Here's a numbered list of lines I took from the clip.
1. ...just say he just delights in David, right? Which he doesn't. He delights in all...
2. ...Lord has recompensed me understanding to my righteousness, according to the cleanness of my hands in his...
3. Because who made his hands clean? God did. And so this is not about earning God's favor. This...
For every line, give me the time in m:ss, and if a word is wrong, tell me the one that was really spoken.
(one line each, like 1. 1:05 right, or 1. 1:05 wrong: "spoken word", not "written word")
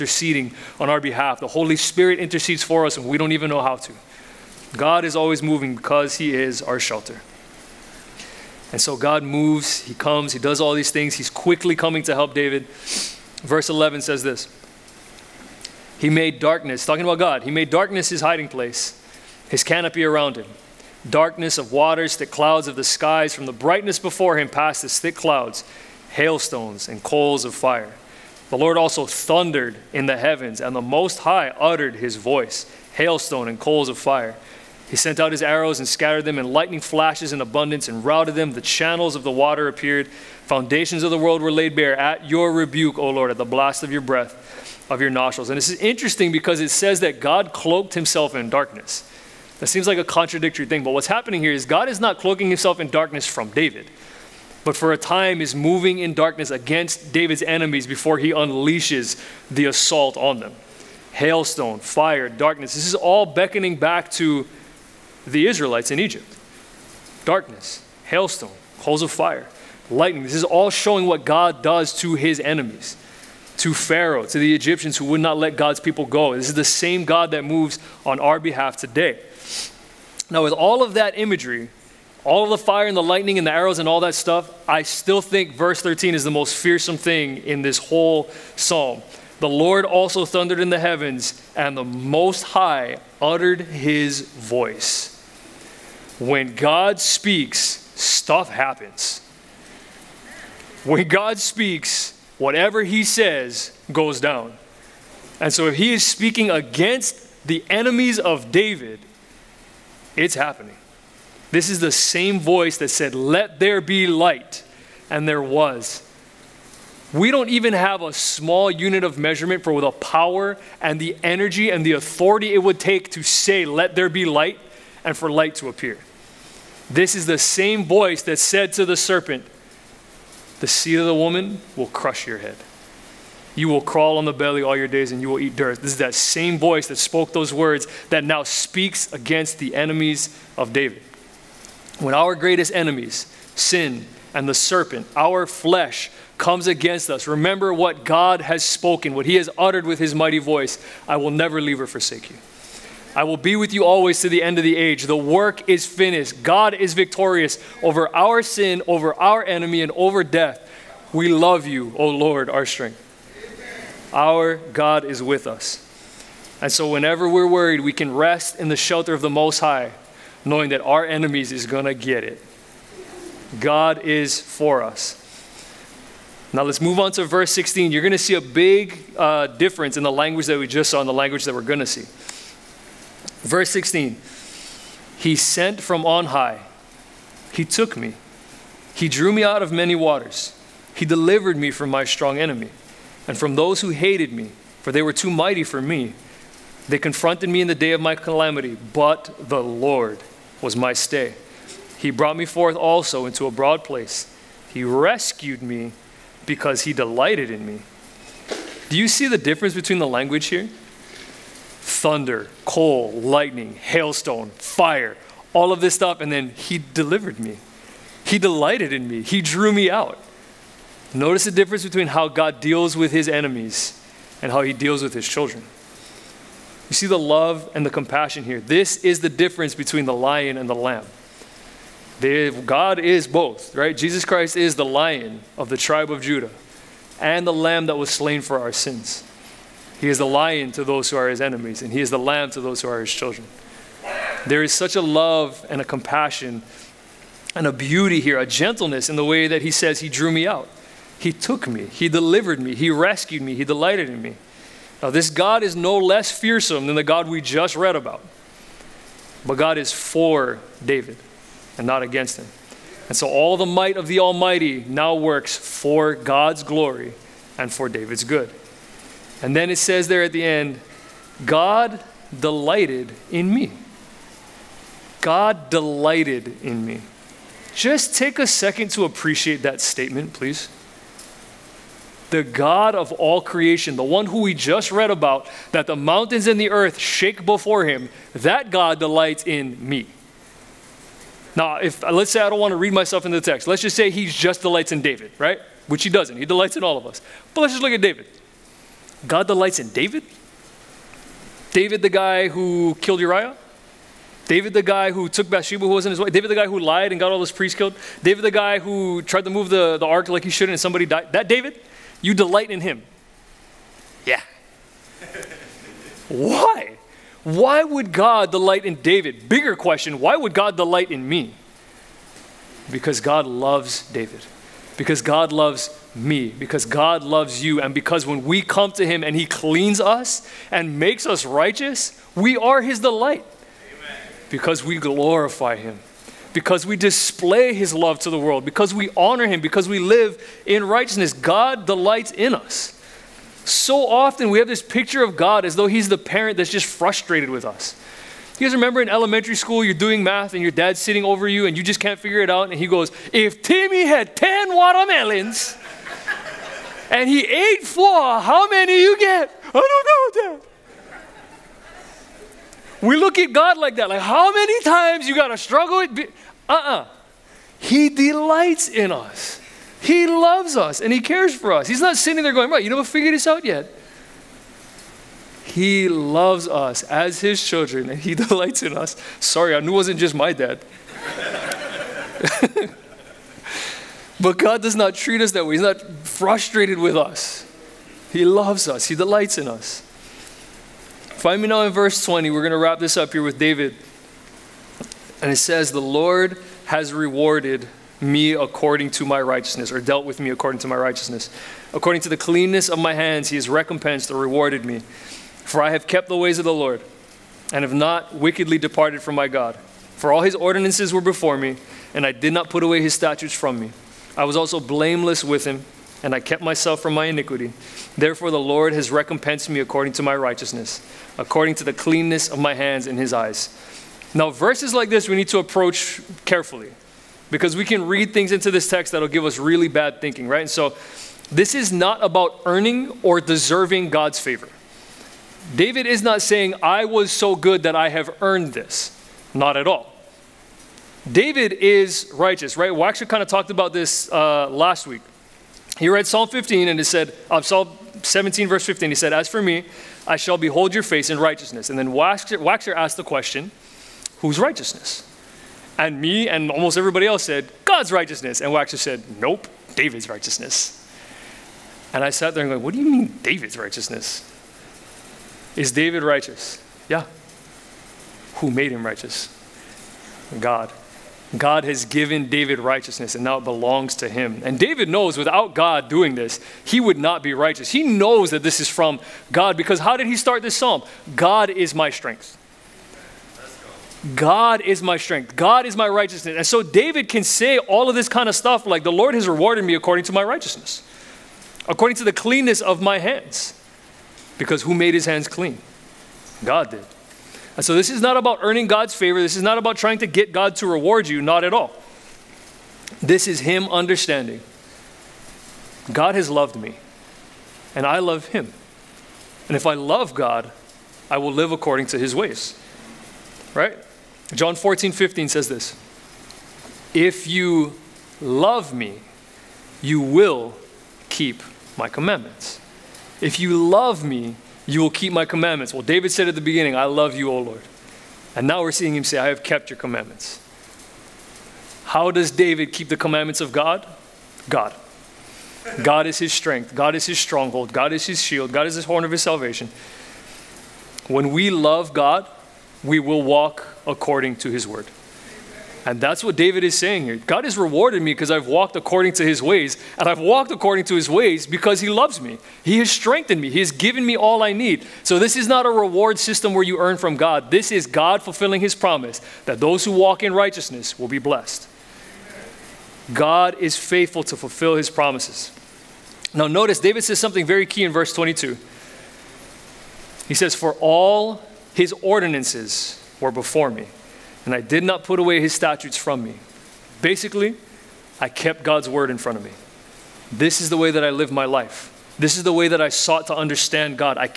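1. 4:53 right
2. 6:58 wrong: "according", not "understanding"
3. 8:14 right.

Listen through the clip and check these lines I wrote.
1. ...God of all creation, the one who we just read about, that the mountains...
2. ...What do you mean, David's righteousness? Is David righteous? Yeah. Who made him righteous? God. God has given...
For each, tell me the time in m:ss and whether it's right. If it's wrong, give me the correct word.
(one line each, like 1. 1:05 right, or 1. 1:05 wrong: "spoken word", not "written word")
1. 4:42 right
2. 7:42 right.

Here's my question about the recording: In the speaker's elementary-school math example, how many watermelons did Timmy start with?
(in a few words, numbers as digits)
10.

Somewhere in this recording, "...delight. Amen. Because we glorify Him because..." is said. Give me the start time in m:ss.
5:33.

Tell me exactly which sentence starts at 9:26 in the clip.
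Now, notice David says something very key in verse 22.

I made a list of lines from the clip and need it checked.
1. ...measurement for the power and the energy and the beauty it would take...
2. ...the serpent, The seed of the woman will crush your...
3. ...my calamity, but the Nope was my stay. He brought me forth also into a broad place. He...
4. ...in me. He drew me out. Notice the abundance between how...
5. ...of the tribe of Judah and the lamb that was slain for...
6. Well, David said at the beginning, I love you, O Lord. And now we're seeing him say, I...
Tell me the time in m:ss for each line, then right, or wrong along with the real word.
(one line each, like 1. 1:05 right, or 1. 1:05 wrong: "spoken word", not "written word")
1. 1:59 wrong: "authority", not "beauty"
2. 2:08 right
3. 3:18 wrong: "Lord", not "Nope"
4. 3:38 wrong: "difference", not "abundance"
5. 3:55 right
6. 8:45 right.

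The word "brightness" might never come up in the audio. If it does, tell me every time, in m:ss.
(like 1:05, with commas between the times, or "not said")
0:23.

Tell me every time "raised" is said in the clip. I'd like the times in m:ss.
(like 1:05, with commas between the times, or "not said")
not said.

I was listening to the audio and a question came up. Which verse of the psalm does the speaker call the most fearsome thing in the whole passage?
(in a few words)
Verse 13.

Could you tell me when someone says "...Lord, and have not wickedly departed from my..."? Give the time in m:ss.
6:46.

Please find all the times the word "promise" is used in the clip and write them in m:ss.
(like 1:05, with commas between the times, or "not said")
9:18, 9:25.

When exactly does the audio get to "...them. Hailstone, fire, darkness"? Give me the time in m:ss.
1:00.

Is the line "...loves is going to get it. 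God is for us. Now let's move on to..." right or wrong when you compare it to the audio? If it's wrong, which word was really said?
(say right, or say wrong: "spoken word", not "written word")
wrong: "enemies", not "loves".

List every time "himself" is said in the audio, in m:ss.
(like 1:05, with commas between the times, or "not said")
0:47, 0:52.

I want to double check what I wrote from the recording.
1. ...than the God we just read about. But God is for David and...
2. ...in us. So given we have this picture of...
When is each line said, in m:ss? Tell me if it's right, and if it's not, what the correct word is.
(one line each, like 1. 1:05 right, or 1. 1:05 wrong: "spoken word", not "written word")
1. 4:16 right
2. 5:42 wrong: "often", not "given".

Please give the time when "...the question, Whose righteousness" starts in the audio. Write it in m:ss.
7:33.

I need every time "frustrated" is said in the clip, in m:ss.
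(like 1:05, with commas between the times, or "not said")
5:46, 6:26.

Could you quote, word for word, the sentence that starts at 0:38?
The channels of the water appeared.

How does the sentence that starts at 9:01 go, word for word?
When we love God, we will walk according to his word.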